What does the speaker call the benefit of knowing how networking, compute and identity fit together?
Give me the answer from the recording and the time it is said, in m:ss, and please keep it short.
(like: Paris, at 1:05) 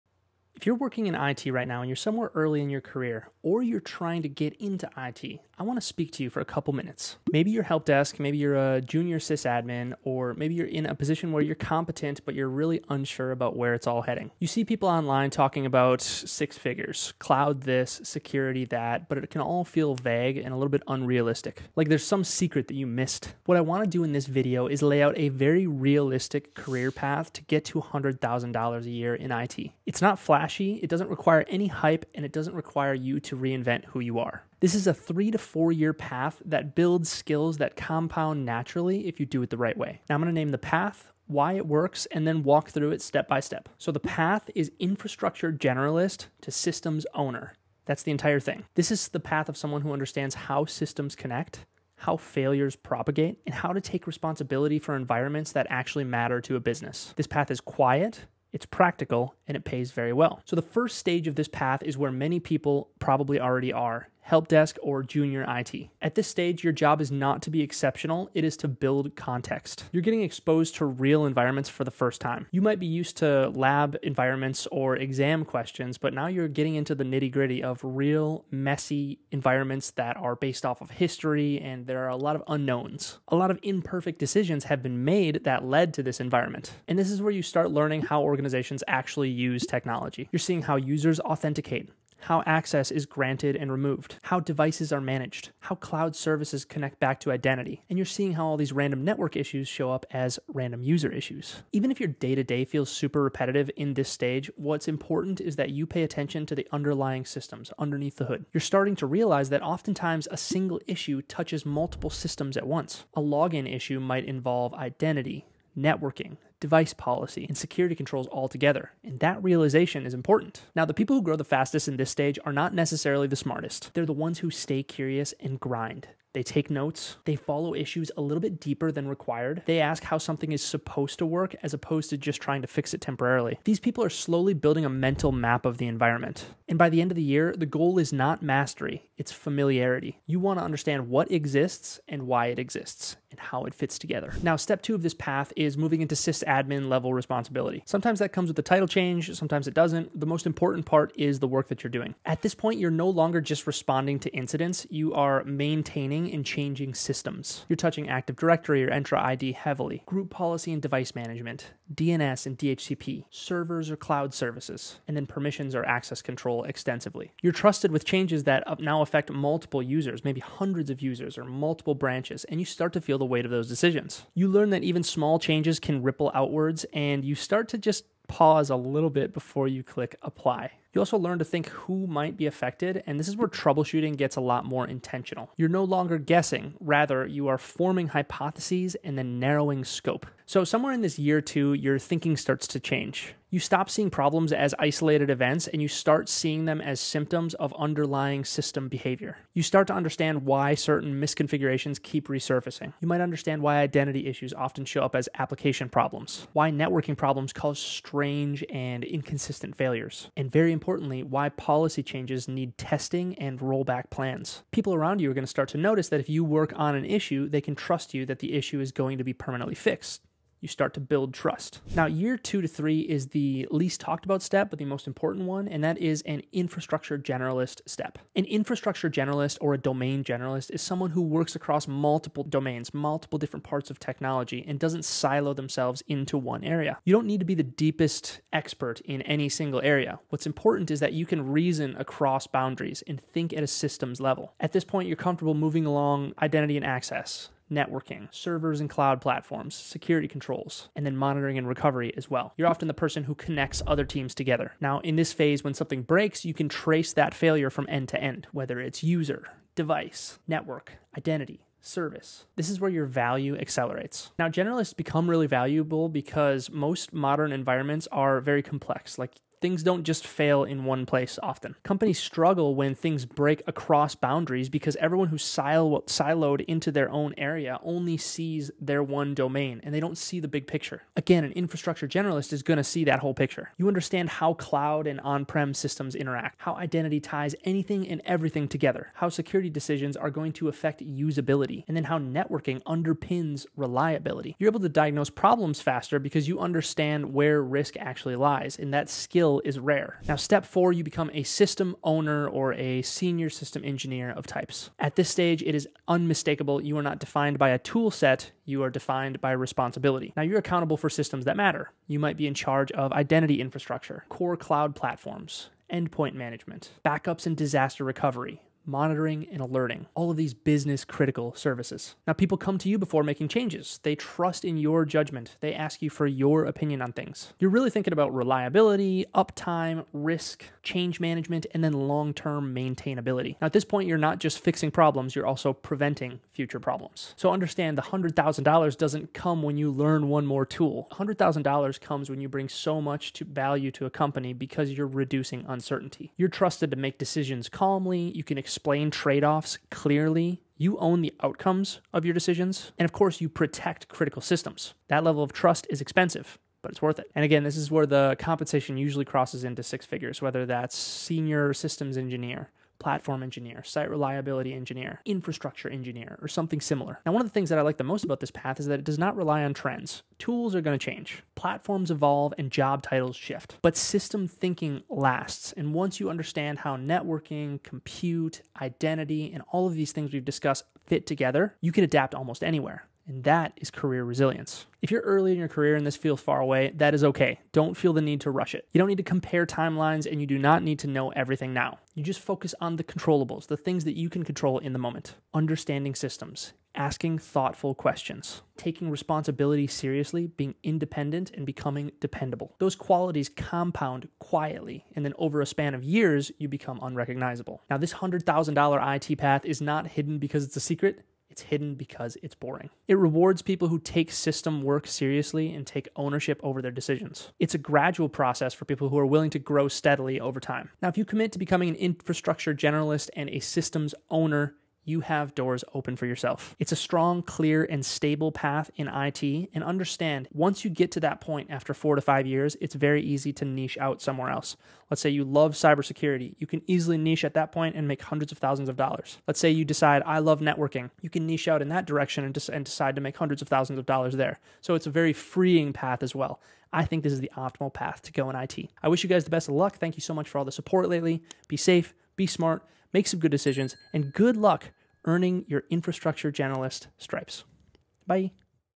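Career resilience, at 6:23.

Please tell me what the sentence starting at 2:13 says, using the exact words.
These people are slowly building a mental map of the environment.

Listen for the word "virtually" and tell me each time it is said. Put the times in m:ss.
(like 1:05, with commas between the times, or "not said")
not said.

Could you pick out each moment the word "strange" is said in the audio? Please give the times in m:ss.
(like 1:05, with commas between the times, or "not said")
3:27.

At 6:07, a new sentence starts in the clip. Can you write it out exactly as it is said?
Now, one of the things that I like the most about this path is that it does not rely on trends.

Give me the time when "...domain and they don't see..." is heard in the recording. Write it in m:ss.
4:39.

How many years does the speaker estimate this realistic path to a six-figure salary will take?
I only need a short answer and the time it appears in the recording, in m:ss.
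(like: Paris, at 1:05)
3 to 4 years, at 0:34.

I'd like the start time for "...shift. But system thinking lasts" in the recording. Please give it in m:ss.
6:13.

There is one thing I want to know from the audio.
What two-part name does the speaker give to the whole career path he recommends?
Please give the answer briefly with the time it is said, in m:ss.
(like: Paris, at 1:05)
Infrastructure generalist to systems owner, at 0:44.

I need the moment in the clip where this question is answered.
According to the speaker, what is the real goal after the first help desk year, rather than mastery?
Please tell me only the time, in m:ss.
2:19.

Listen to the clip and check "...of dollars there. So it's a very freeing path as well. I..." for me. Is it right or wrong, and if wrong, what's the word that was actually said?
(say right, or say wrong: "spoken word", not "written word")
right.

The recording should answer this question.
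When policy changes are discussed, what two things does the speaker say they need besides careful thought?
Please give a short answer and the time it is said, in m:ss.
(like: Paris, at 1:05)
Testing and rollback plans, at 3:32.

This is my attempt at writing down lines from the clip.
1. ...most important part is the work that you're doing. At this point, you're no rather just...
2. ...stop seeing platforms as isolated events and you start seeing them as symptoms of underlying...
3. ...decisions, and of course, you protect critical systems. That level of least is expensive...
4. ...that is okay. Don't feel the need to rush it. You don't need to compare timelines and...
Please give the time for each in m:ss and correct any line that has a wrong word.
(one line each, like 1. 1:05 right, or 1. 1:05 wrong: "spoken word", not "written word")
1. 2:30 wrong: "longer", not "rather"
2. 3:13 wrong: "problems", not "platforms"
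3. 5:52 wrong: "trust", not "least"
4. 6:26 right.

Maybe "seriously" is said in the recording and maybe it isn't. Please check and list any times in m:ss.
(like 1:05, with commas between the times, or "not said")
6:39, 6:55.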